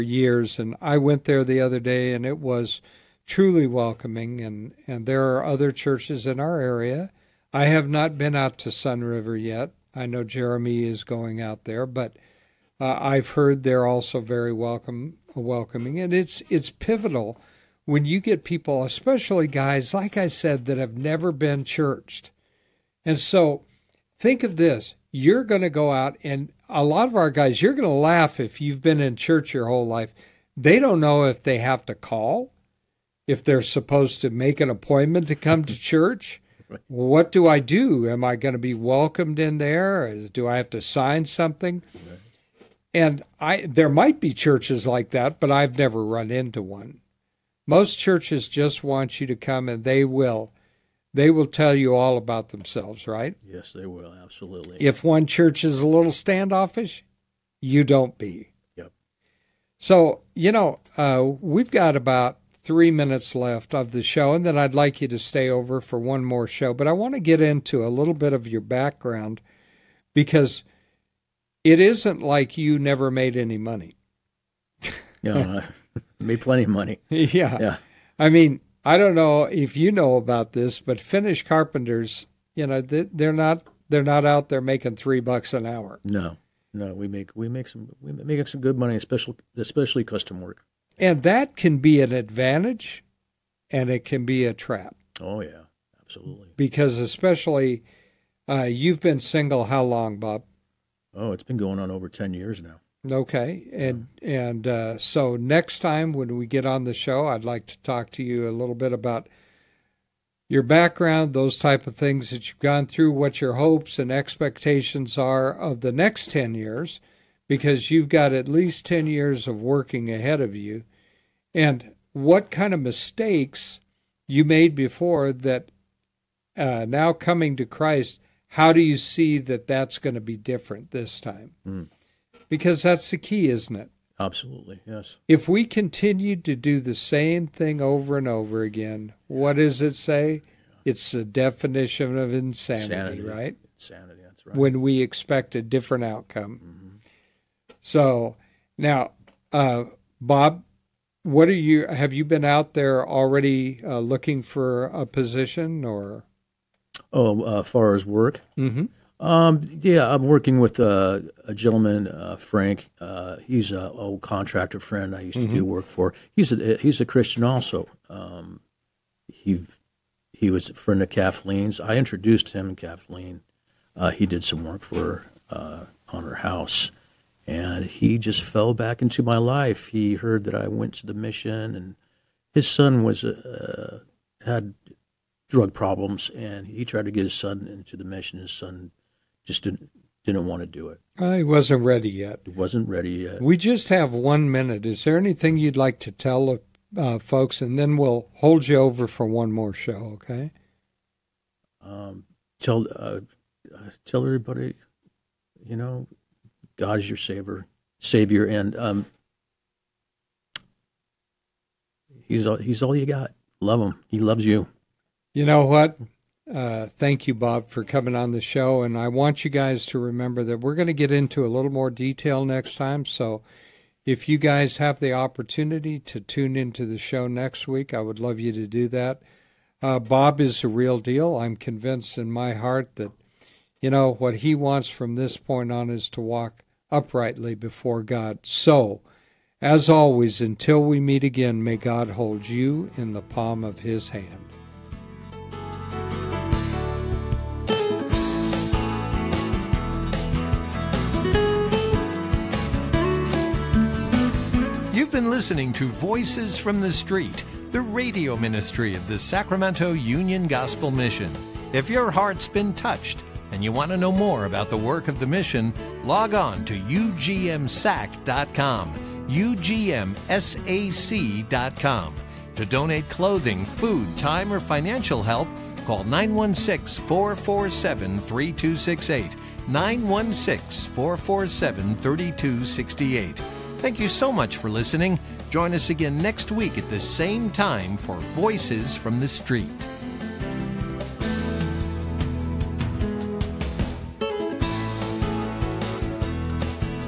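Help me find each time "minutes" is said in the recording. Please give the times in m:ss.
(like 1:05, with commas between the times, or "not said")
1:02, 3:14.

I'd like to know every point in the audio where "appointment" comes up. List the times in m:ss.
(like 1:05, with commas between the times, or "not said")
0:34.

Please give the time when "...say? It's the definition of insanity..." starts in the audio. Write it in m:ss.
2:19.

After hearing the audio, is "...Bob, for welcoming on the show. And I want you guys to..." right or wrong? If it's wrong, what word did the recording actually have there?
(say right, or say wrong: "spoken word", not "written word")
wrong: "coming", not "welcoming".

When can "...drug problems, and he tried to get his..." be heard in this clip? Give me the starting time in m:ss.
3:05.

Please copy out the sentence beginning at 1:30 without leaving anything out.
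And that can be an advantage, and it can be a trap.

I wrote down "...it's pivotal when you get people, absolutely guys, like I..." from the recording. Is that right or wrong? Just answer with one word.
wrong.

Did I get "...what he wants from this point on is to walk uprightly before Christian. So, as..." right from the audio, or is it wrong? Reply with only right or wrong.
wrong.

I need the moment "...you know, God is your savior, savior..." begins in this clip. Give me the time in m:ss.
3:25.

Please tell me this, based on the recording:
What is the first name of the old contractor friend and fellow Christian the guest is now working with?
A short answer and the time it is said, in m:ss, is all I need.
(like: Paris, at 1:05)
Frank, at 2:42.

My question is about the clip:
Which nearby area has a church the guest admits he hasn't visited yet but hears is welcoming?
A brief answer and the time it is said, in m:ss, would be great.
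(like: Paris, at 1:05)
Sun River, at 0:08.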